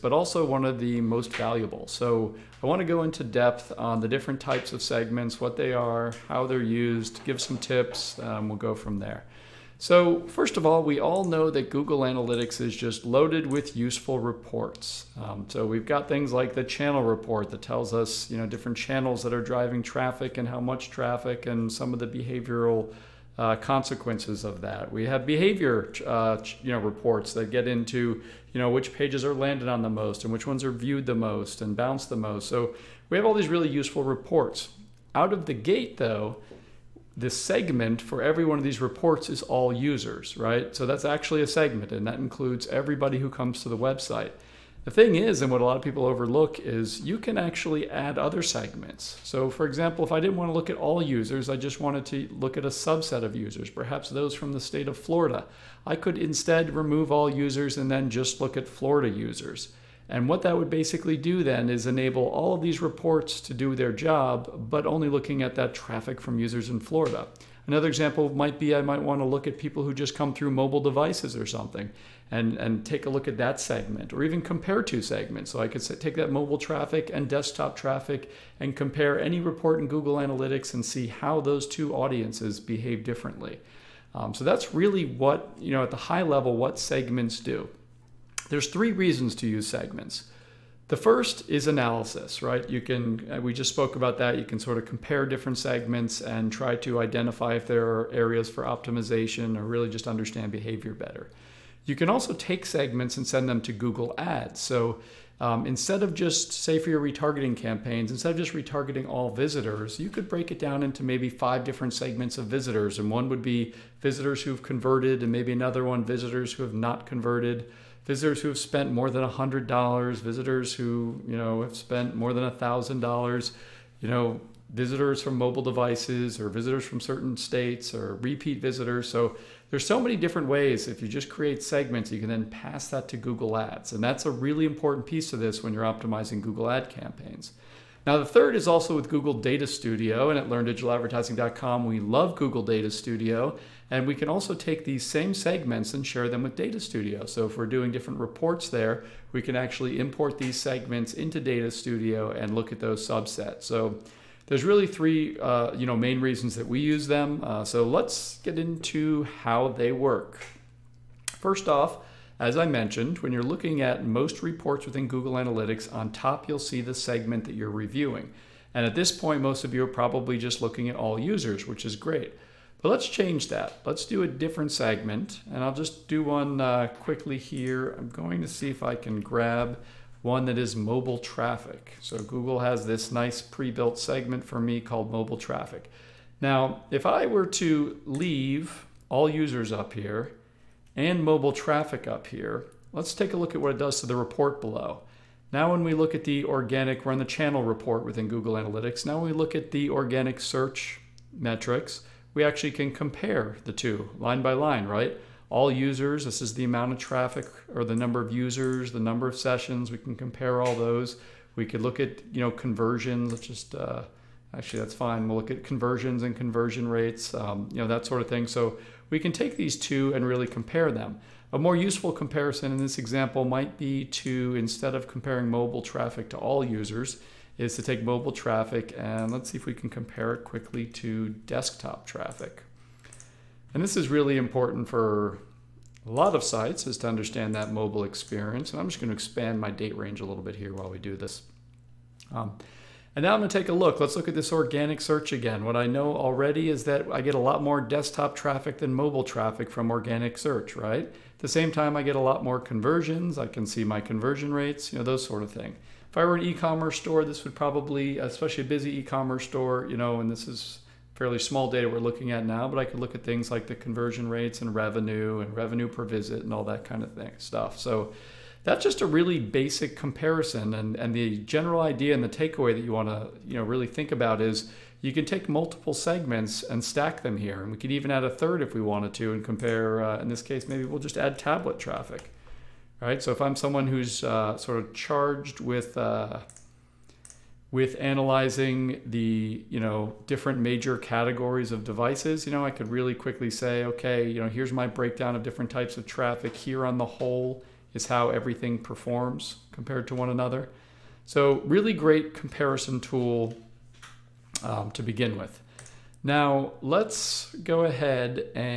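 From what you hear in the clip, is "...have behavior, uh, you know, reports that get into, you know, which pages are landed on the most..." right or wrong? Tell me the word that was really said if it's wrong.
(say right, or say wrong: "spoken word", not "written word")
right.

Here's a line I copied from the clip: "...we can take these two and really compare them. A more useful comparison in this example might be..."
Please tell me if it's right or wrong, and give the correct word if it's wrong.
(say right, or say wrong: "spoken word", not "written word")
right.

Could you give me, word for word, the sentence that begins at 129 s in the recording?
So there's so many different ways.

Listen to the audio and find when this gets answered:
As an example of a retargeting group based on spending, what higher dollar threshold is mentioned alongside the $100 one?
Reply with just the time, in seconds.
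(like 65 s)
122 s.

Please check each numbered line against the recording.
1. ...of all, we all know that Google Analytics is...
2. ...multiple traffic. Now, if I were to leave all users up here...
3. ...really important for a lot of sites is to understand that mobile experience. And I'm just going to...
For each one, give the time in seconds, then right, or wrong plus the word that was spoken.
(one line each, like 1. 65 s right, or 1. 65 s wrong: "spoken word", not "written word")
1. 10 s right
2. 185 s wrong: "mobile", not "multiple"
3. 234 s right.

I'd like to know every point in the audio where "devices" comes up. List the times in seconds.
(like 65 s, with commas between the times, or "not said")
70 s, 125 s, 291 s.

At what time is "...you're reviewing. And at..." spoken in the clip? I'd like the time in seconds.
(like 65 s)
167 s.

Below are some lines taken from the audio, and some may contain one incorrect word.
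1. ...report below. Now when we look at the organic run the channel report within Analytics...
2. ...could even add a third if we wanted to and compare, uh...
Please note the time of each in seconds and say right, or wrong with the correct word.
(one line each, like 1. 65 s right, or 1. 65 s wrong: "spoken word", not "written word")
1. 194 s wrong: "Google", not "Analytics"
2. 277 s right.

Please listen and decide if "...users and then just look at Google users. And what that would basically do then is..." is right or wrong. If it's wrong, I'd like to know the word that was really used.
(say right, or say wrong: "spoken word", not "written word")
wrong: "Florida", not "Google".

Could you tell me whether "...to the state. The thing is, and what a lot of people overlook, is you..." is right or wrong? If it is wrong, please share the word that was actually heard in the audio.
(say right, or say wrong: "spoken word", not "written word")
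wrong: "website", not "state".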